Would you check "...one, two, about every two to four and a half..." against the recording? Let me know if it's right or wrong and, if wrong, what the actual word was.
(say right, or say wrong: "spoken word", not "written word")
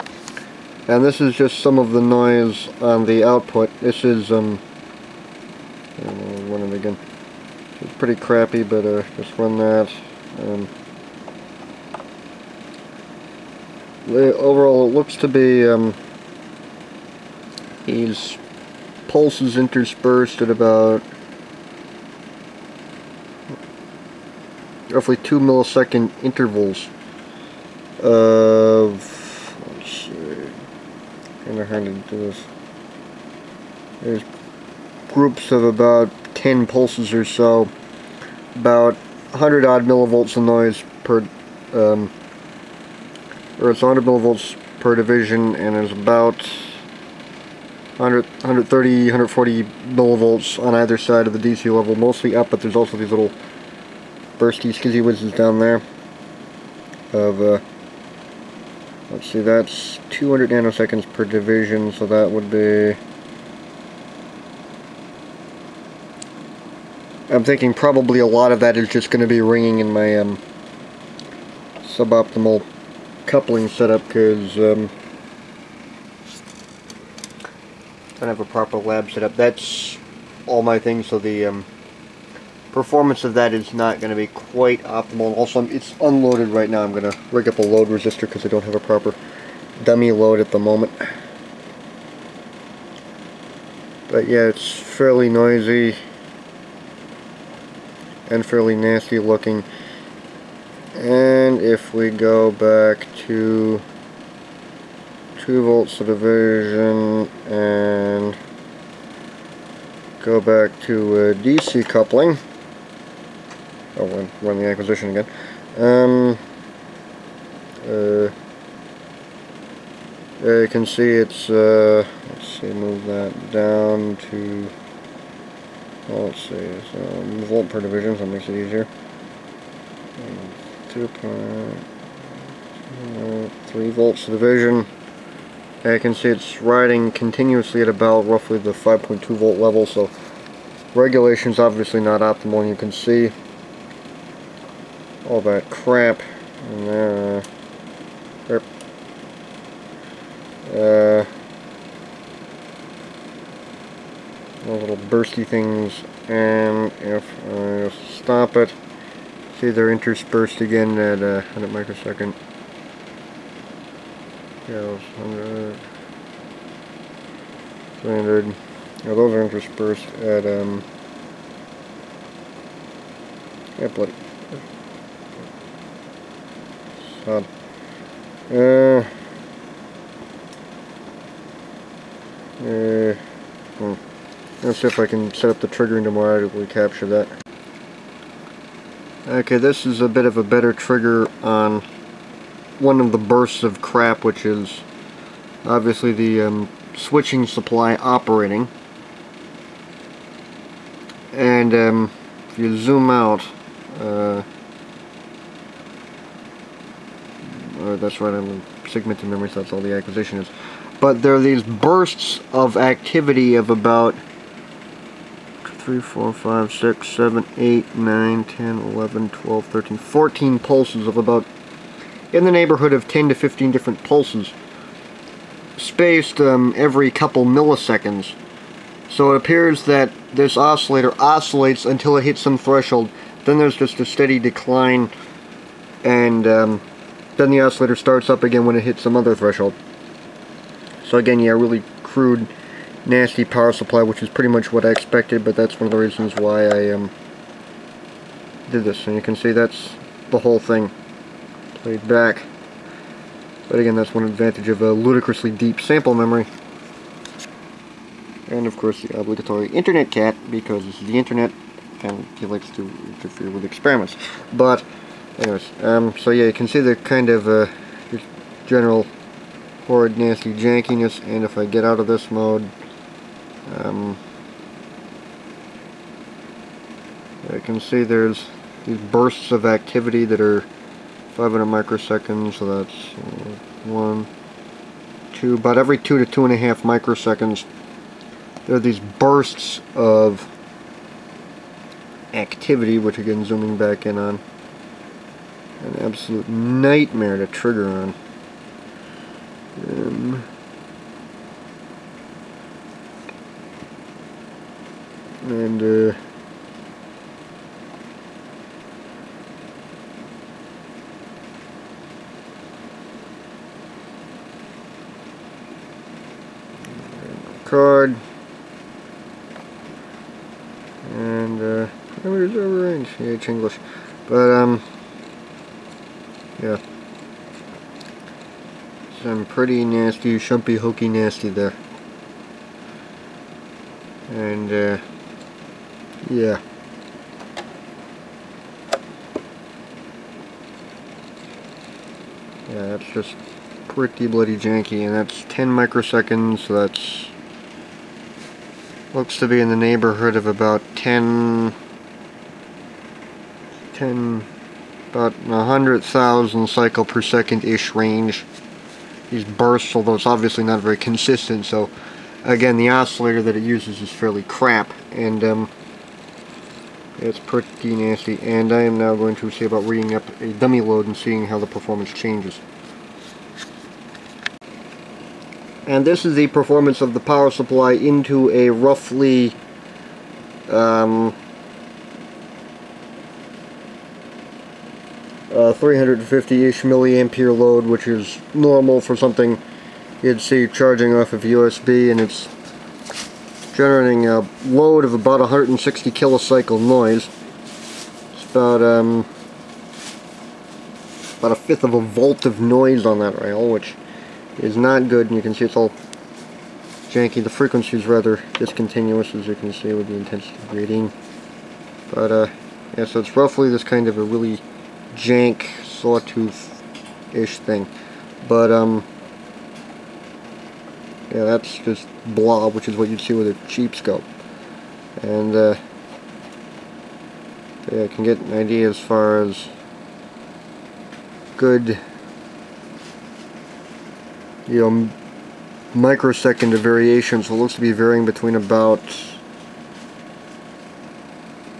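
wrong: "two", not "four".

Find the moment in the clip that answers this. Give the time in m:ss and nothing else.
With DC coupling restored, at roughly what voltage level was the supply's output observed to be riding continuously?
2:18.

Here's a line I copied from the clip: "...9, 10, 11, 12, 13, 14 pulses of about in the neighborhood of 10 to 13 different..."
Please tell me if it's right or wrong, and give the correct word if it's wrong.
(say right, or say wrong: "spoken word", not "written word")
wrong: "15", not "13".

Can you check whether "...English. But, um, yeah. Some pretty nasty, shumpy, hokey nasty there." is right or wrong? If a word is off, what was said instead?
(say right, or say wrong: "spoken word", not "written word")
right.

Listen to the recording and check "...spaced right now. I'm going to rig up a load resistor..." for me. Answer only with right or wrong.
wrong.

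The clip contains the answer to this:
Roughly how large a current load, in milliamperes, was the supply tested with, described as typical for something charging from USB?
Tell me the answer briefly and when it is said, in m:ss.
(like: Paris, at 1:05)
350 milliamperes, at 6:25.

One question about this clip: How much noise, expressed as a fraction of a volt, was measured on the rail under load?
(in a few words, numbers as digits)
a fifth of a volt.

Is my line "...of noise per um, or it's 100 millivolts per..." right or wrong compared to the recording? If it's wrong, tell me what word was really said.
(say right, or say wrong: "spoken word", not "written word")
right.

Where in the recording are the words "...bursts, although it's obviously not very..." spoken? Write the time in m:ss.
5:59.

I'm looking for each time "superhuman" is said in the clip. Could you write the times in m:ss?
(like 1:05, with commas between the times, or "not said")
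not said.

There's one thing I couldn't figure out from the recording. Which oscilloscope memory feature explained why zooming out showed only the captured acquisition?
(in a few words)
segmented memory.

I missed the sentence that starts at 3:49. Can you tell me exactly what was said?
So it appears that this oscillator oscillates until it hits some threshold.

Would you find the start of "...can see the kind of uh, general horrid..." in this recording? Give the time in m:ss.
4:26.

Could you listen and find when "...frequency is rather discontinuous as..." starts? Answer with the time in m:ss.
6:47.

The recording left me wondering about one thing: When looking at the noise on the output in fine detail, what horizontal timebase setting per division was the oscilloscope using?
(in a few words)
200 nanoseconds.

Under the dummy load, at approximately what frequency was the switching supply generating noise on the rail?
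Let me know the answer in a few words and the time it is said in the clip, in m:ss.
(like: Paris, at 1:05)
160 kilocycles, at 6:35.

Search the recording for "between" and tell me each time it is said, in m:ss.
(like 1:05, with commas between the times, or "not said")
7:18.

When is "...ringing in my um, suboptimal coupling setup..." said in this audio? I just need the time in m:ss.
1:09.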